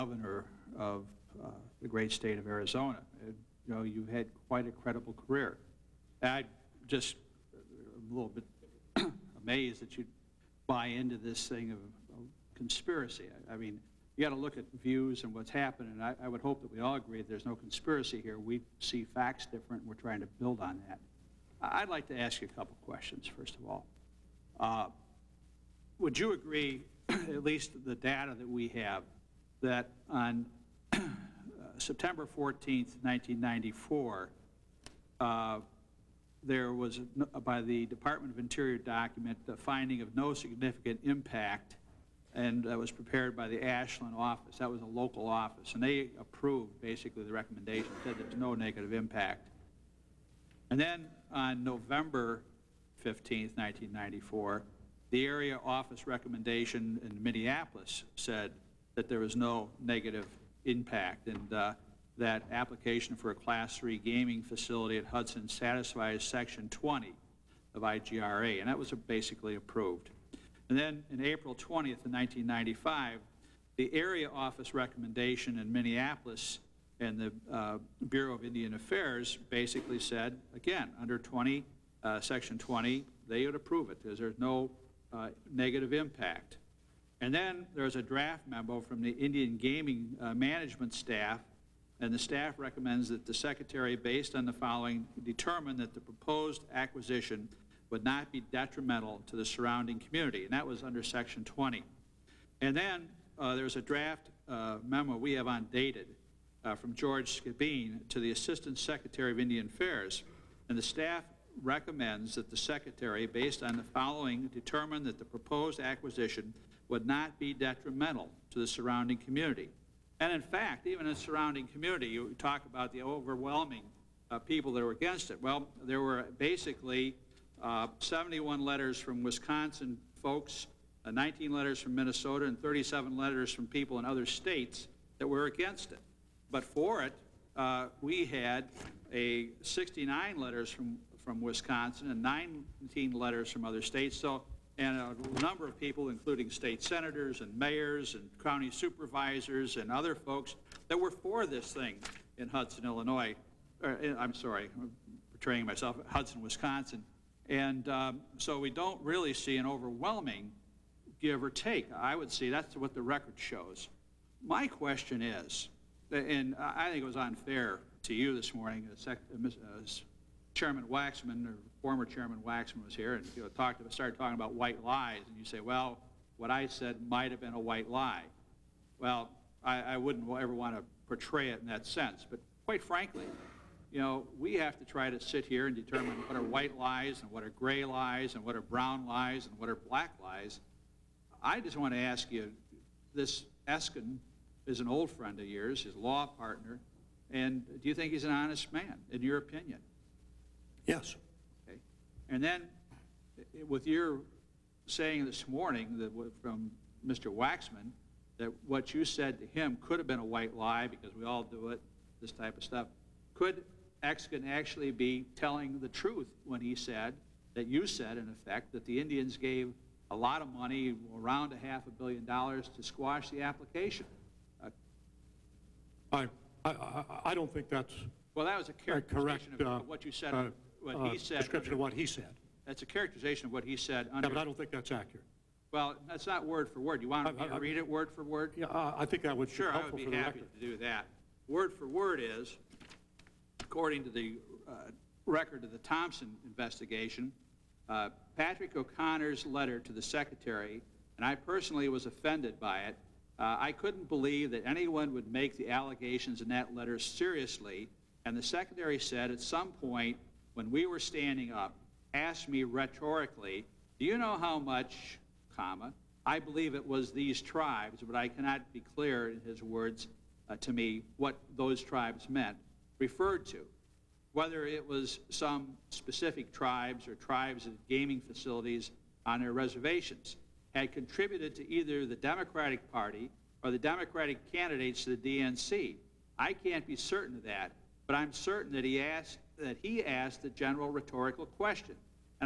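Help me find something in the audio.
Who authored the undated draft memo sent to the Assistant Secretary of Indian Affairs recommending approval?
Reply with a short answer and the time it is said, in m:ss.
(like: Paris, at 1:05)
George Skibine, at 1:46.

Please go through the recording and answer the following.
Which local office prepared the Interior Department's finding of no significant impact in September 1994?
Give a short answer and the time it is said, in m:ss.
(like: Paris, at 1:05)
Ashland, at 0:43.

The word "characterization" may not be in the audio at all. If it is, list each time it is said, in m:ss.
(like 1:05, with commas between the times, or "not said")
3:48, 3:52.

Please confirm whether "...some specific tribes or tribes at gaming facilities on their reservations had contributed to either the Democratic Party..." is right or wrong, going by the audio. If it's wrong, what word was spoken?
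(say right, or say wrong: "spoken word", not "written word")
right.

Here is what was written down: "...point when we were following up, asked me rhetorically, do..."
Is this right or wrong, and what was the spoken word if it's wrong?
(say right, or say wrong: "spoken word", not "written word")
wrong: "standing", not "following".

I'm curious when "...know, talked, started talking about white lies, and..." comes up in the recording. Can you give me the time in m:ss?
2:53.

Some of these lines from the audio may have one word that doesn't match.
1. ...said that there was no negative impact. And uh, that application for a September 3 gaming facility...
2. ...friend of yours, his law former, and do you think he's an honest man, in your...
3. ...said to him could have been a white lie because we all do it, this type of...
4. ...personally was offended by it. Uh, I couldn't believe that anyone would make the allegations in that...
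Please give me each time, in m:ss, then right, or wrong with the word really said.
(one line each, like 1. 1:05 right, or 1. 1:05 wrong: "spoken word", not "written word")
1. 0:58 wrong: "Class", not "September"
2. 3:15 wrong: "partner", not "former"
3. 3:29 right
4. 4:11 right.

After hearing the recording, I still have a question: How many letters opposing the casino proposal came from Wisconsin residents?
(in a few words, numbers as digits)
71.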